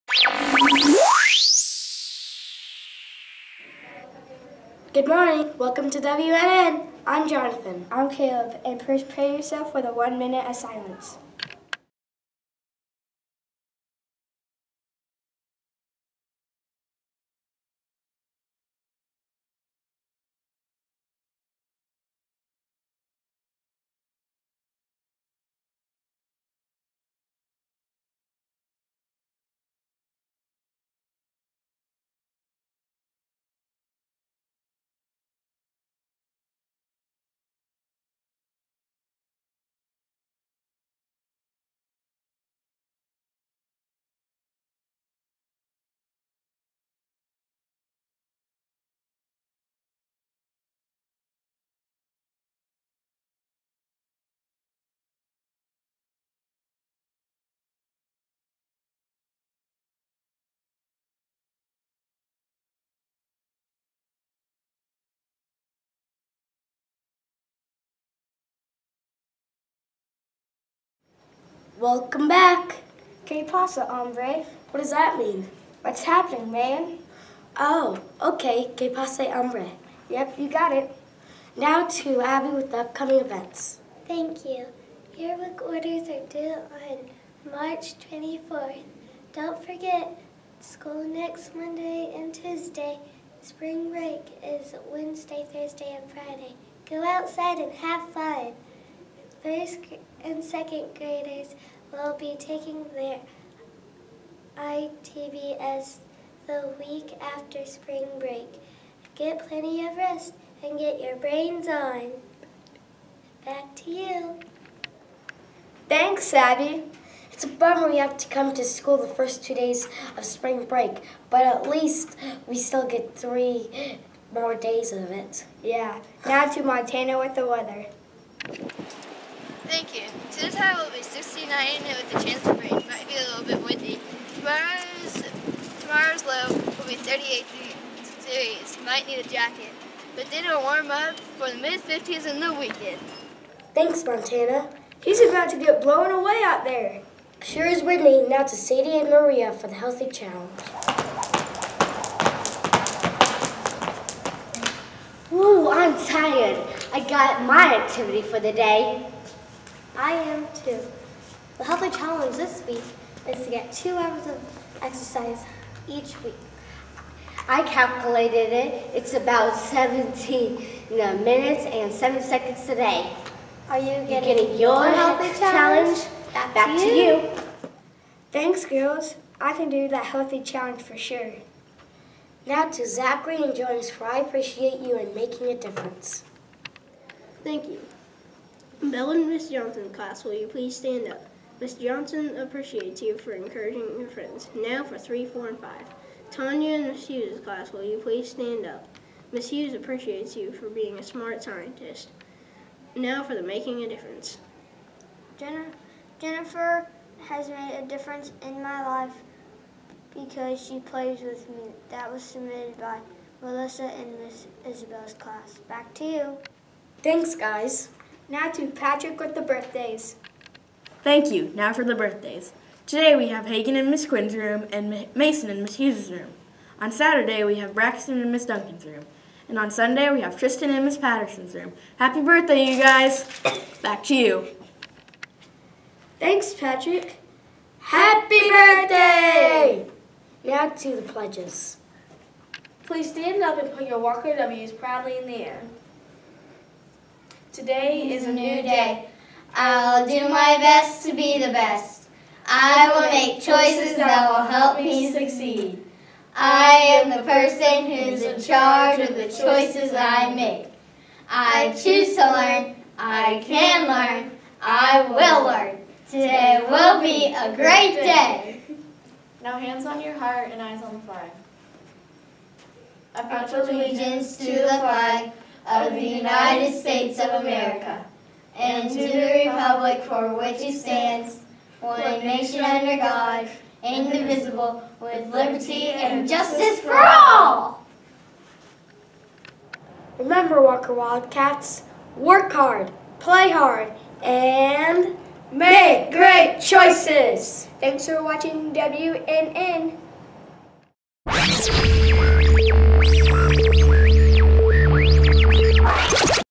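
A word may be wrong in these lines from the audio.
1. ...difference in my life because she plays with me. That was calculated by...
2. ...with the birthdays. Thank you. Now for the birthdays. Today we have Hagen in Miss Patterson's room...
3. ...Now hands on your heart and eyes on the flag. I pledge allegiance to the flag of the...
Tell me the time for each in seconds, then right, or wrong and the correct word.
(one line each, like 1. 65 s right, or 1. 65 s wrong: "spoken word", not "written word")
1. 207 s wrong: "submitted", not "calculated"
2. 219 s wrong: "Quinn", not "Patterson"
3. 269 s right.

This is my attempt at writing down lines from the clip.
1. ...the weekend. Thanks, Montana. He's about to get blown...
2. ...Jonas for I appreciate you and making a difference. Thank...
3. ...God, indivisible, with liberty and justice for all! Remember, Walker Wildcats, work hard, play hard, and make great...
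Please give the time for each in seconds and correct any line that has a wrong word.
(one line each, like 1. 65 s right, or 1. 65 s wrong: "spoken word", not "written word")
1. 142 s right
2. 183 s right
3. 282 s right.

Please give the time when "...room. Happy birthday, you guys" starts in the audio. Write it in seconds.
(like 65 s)
231 s.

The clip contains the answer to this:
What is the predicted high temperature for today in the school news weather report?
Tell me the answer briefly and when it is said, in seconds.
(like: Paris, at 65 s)
69, at 131 s.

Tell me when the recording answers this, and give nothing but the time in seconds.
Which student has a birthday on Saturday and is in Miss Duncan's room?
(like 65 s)
227 s.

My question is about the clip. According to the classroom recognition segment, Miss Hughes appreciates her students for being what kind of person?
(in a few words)
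a smart scientist.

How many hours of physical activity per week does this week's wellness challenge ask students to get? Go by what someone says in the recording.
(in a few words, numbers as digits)
2 hours.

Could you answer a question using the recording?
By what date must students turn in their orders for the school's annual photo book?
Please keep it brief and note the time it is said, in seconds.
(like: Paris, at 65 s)
March 24th, at 87 s.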